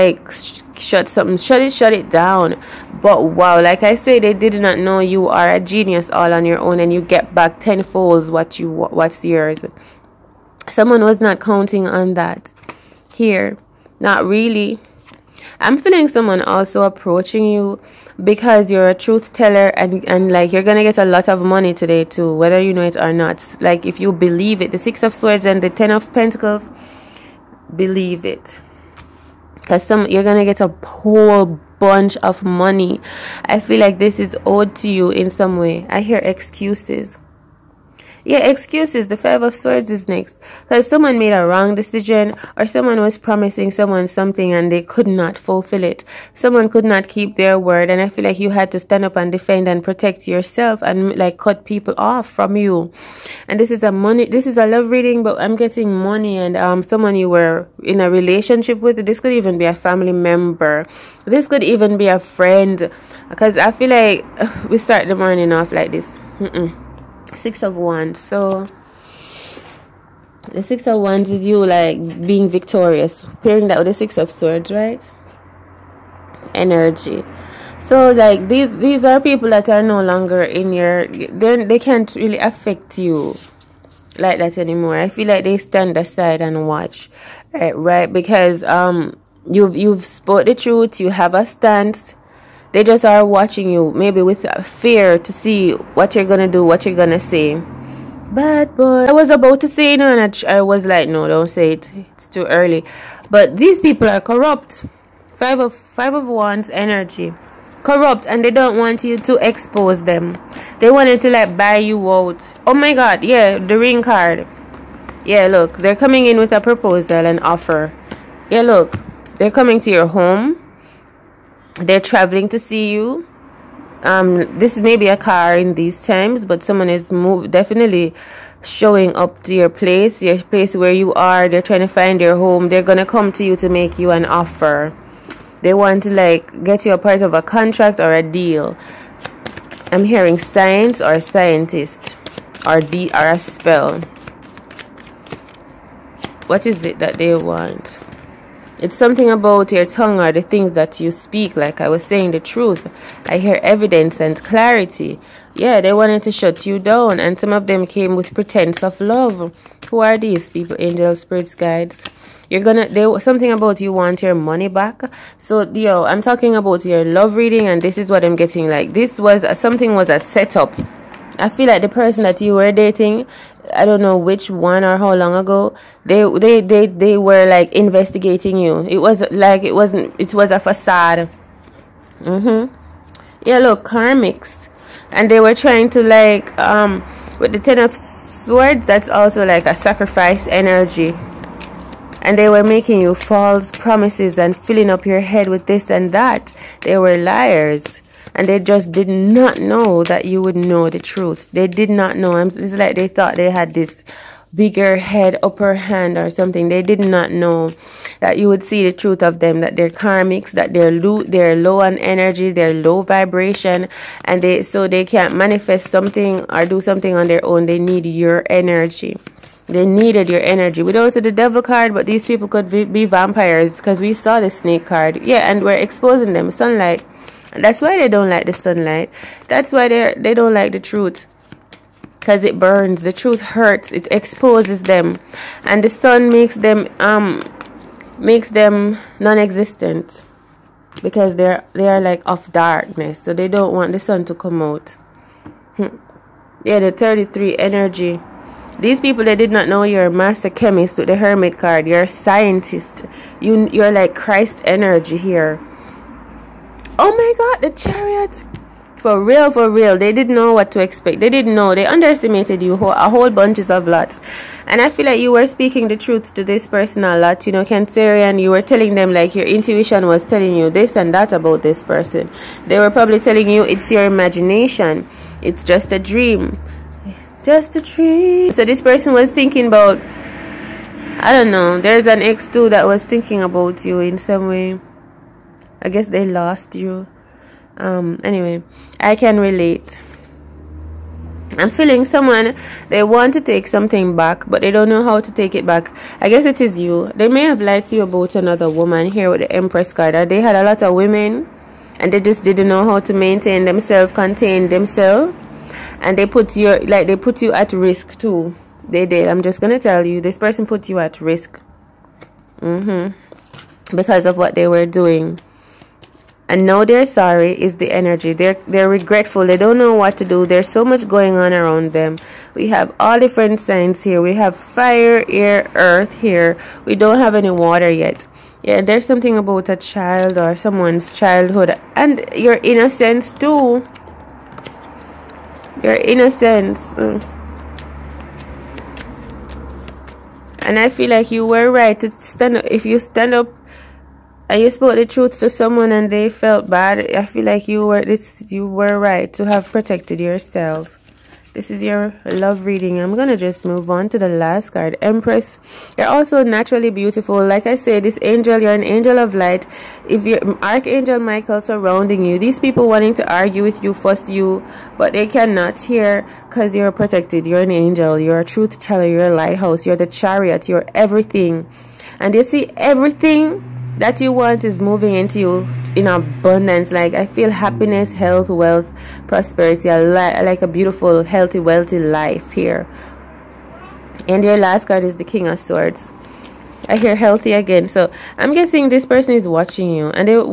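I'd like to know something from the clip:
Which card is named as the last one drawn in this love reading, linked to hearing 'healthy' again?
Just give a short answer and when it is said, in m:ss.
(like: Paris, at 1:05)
King of Swords, at 6:25.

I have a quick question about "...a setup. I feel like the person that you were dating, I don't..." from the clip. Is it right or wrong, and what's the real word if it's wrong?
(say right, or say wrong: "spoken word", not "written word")
right.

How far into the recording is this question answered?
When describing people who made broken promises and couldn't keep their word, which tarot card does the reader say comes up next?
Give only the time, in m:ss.
0:39.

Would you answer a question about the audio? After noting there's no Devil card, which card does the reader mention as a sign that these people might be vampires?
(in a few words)
Snake card.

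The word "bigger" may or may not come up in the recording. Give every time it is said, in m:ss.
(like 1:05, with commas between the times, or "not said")
3:24.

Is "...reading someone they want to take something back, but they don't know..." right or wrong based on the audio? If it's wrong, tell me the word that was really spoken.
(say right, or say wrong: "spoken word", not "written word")
wrong: "feeling", not "reading".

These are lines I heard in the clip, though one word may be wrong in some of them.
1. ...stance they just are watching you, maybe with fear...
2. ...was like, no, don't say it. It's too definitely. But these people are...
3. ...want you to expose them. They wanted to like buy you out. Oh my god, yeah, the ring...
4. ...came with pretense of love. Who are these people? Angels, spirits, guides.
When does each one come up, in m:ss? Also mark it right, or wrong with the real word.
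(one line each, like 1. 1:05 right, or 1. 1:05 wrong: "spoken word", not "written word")
1. 1:31 right
2. 1:40 wrong: "early", not "definitely"
3. 1:48 right
4. 2:37 right.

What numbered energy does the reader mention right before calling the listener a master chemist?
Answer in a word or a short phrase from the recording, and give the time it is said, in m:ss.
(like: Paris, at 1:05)
33, at 4:06.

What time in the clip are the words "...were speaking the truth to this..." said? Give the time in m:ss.
4:25.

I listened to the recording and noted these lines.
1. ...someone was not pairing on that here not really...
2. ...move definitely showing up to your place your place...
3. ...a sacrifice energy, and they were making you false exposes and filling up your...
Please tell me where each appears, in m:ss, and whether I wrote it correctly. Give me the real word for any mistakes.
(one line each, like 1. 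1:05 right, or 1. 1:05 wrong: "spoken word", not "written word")
1. 0:10 wrong: "counting", not "pairing"
2. 2:07 right
3. 3:09 wrong: "promises", not "exposes".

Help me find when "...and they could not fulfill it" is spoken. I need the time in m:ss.
0:44.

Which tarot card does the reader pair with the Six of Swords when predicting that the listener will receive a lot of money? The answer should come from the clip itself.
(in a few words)
Ten of Pentacles.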